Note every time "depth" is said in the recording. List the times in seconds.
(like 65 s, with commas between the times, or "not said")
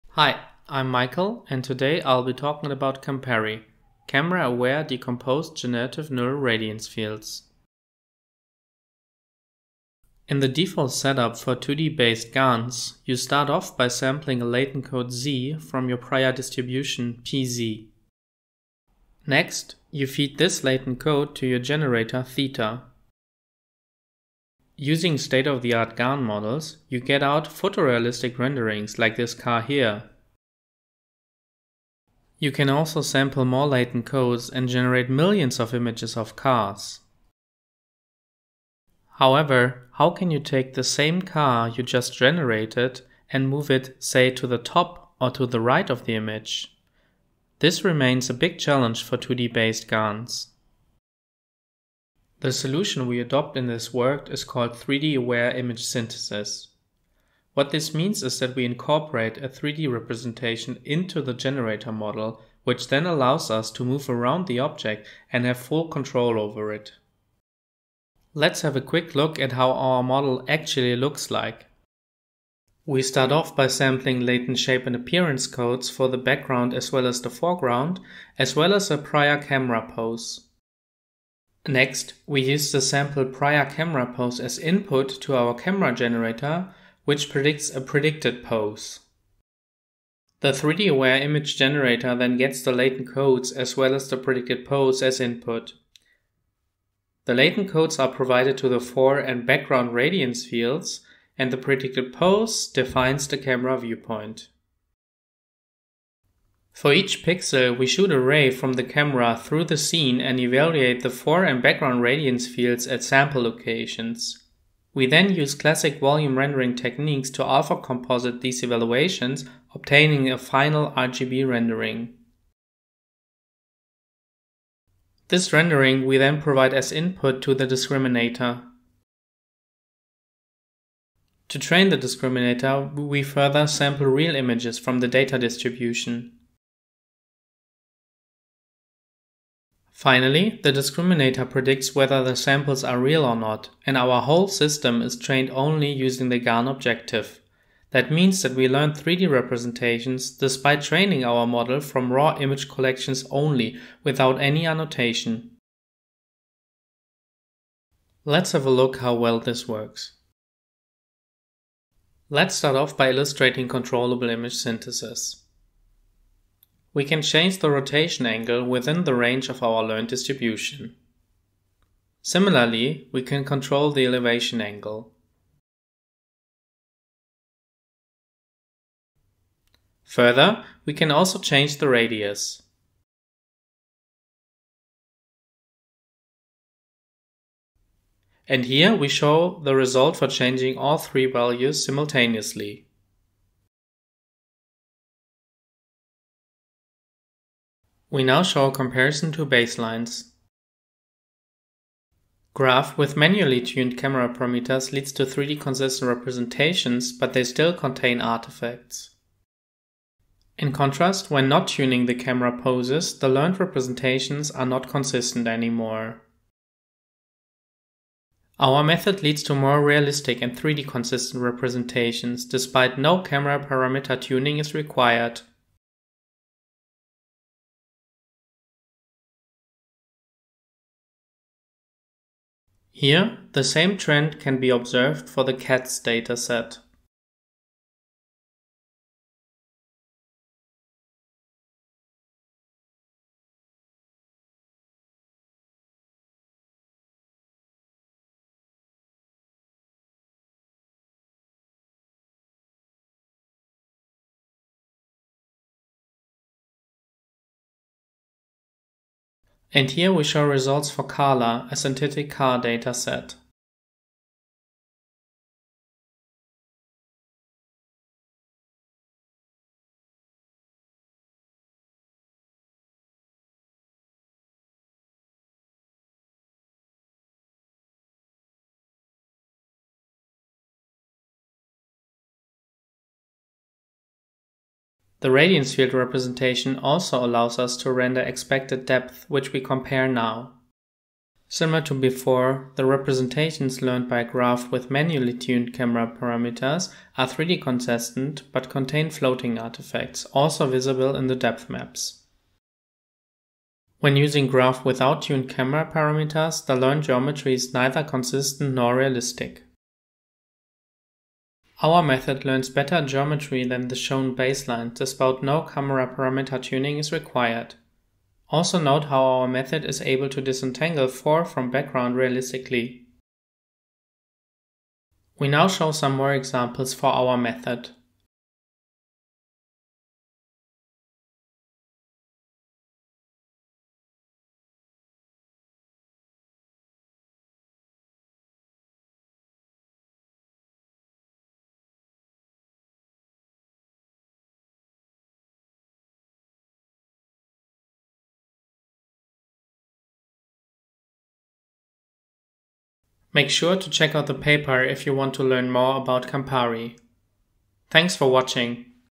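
288 s, 301 s.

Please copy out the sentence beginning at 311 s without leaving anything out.
Our method learns better geometry than the shown baseline, despite no camera parameter tuning is required.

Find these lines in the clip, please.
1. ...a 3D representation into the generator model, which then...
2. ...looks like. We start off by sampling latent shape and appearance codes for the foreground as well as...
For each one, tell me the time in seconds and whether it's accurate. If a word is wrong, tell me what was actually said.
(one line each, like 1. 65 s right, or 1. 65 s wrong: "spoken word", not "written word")
1. 59 s right
2. 70 s wrong: "background", not "foreground".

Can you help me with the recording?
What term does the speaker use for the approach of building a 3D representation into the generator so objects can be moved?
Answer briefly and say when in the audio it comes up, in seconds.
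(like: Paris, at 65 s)
3D Aware Image Synthesis, at 54 s.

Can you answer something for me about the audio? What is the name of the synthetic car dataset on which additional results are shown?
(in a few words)
Carla.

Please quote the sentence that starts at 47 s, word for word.
This remains a big challenge for 2D-based GANs.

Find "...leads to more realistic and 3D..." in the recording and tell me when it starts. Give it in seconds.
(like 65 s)
219 s.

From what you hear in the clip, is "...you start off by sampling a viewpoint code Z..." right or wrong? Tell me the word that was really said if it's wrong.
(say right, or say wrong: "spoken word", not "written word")
wrong: "latent", not "viewpoint".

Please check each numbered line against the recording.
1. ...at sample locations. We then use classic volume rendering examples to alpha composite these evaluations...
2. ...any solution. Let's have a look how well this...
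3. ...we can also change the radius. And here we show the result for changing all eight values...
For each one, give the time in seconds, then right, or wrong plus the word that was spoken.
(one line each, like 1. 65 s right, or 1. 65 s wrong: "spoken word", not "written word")
1. 112 s wrong: "techniques", not "examples"
2. 154 s wrong: "annotation", not "solution"
3. 180 s wrong: "three", not "eight".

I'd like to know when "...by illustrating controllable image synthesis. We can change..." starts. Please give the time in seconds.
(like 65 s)
162 s.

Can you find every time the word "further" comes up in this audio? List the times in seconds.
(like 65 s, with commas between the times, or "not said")
133 s, 180 s.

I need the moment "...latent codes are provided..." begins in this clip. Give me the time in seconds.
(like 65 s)
97 s.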